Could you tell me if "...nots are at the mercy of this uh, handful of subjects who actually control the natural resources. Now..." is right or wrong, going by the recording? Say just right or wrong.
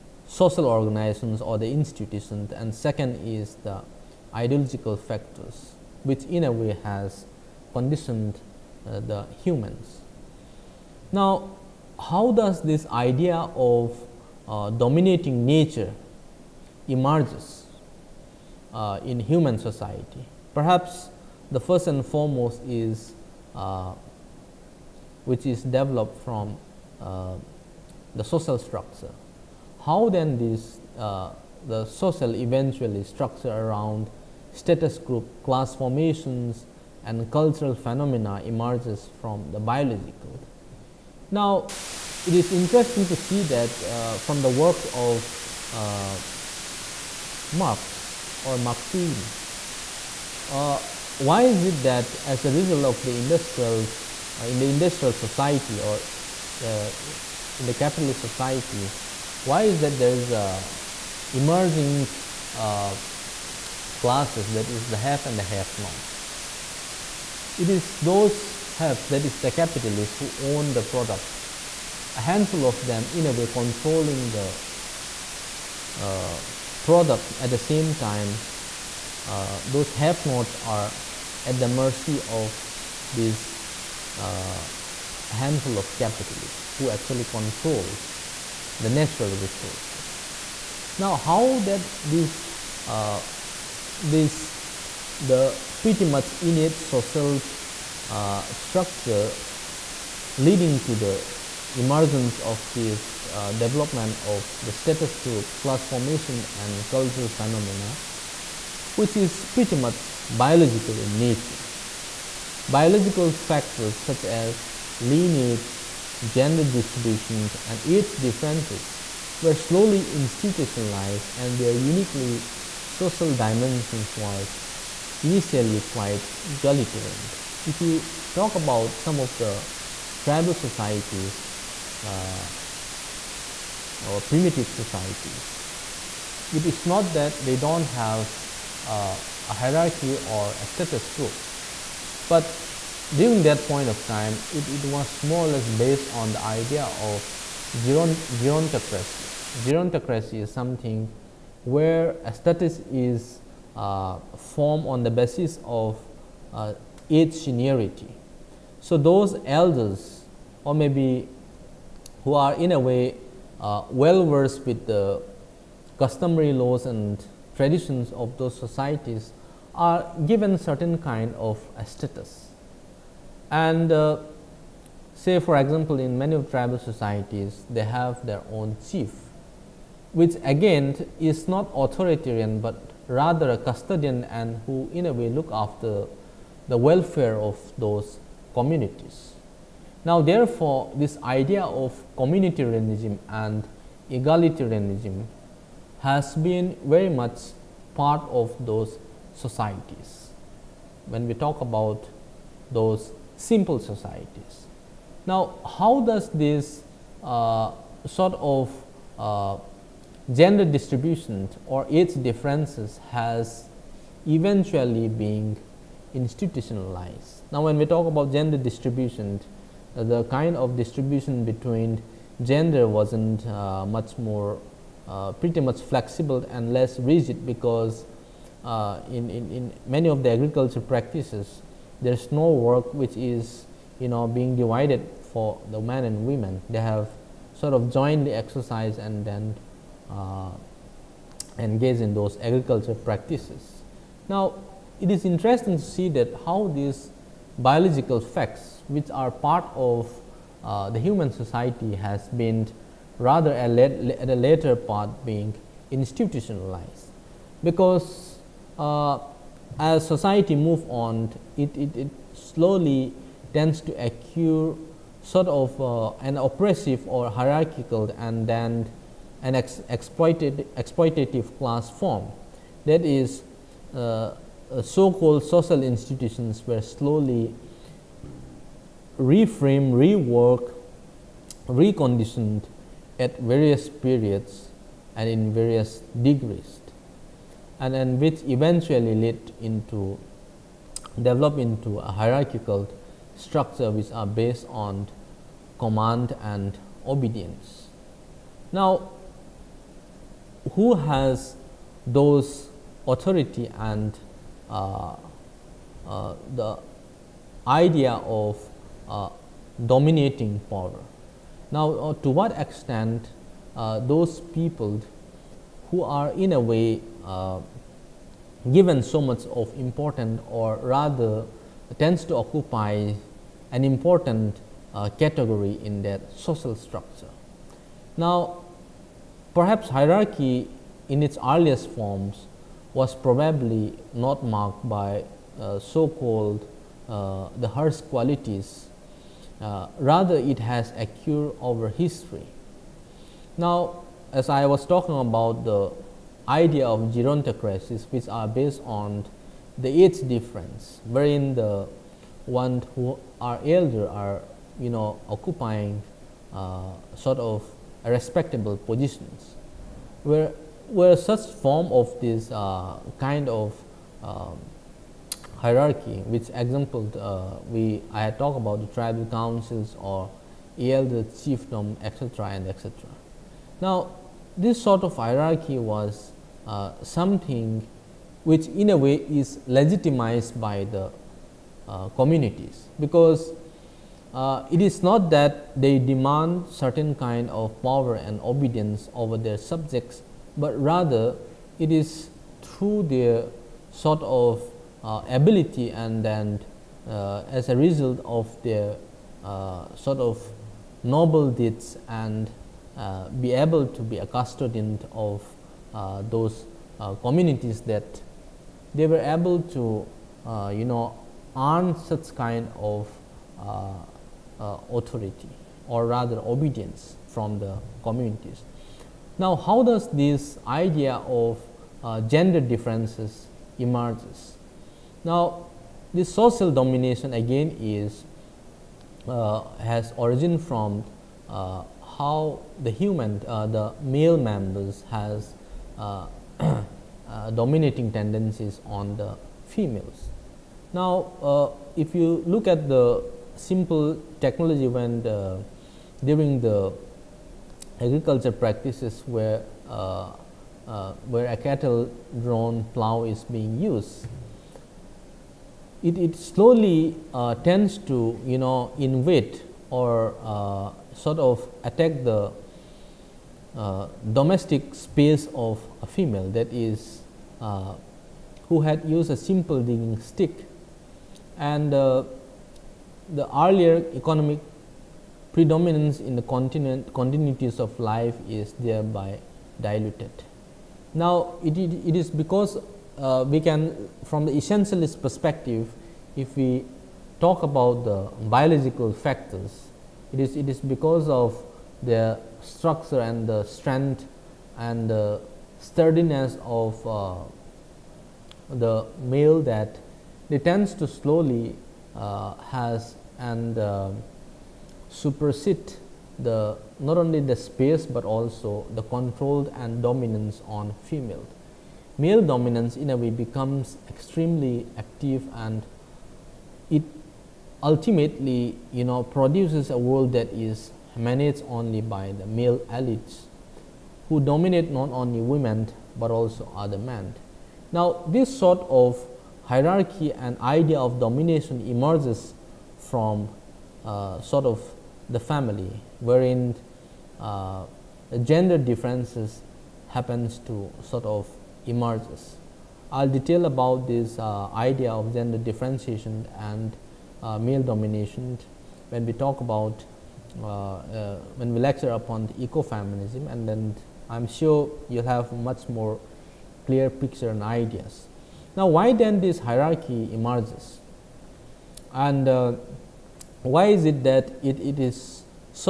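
wrong.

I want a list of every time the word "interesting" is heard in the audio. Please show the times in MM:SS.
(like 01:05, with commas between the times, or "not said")
00:42, 04:05.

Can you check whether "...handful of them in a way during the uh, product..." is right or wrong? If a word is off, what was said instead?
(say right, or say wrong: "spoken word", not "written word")
wrong: "controlling", not "during".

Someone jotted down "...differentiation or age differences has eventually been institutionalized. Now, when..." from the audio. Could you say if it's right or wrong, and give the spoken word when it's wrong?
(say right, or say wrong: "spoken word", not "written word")
wrong: "distribution", not "differentiation".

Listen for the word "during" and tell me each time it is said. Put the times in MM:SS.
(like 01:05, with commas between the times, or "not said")
02:23, 07:26.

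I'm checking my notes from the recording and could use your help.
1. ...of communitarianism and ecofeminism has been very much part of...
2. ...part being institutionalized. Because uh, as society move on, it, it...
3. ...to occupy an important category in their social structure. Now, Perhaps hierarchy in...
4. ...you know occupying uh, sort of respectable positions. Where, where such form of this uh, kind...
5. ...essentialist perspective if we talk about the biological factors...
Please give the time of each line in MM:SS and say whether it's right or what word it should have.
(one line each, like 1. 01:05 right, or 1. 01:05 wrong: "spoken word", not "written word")
1. 03:11 wrong: "egalitarianism", not "ecofeminism"
2. 04:14 right
3. 05:22 right
4. 05:54 right
5. 08:04 right.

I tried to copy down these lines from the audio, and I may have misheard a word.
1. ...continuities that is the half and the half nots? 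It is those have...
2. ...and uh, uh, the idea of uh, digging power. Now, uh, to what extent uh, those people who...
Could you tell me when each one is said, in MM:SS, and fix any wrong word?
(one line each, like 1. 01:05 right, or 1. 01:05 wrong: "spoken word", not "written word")
1. 01:03 wrong: "classes", not "continuities"
2. 05:03 wrong: "dominating", not "digging".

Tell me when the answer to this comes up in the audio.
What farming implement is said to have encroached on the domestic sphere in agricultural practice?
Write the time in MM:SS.
07:31.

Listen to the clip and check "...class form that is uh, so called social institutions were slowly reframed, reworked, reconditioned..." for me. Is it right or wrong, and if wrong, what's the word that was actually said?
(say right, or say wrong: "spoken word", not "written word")
right.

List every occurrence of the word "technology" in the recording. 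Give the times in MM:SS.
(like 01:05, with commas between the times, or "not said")
07:24.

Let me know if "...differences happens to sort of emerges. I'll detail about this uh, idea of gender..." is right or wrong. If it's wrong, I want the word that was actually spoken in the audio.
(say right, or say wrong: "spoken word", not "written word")
right.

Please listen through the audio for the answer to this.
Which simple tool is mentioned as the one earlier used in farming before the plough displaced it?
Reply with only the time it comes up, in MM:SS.
07:49.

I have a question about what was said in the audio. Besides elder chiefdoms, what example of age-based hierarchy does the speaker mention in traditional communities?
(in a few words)
tribal councils.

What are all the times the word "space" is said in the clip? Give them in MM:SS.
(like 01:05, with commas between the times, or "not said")
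07:44, 08:27.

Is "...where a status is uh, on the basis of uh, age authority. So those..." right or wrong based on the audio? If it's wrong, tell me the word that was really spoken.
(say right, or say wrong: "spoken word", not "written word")
wrong: "seniority", not "authority".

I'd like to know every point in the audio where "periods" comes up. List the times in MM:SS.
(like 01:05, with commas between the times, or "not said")
04:43.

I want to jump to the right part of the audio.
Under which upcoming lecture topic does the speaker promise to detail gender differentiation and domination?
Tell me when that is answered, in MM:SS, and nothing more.
09:12.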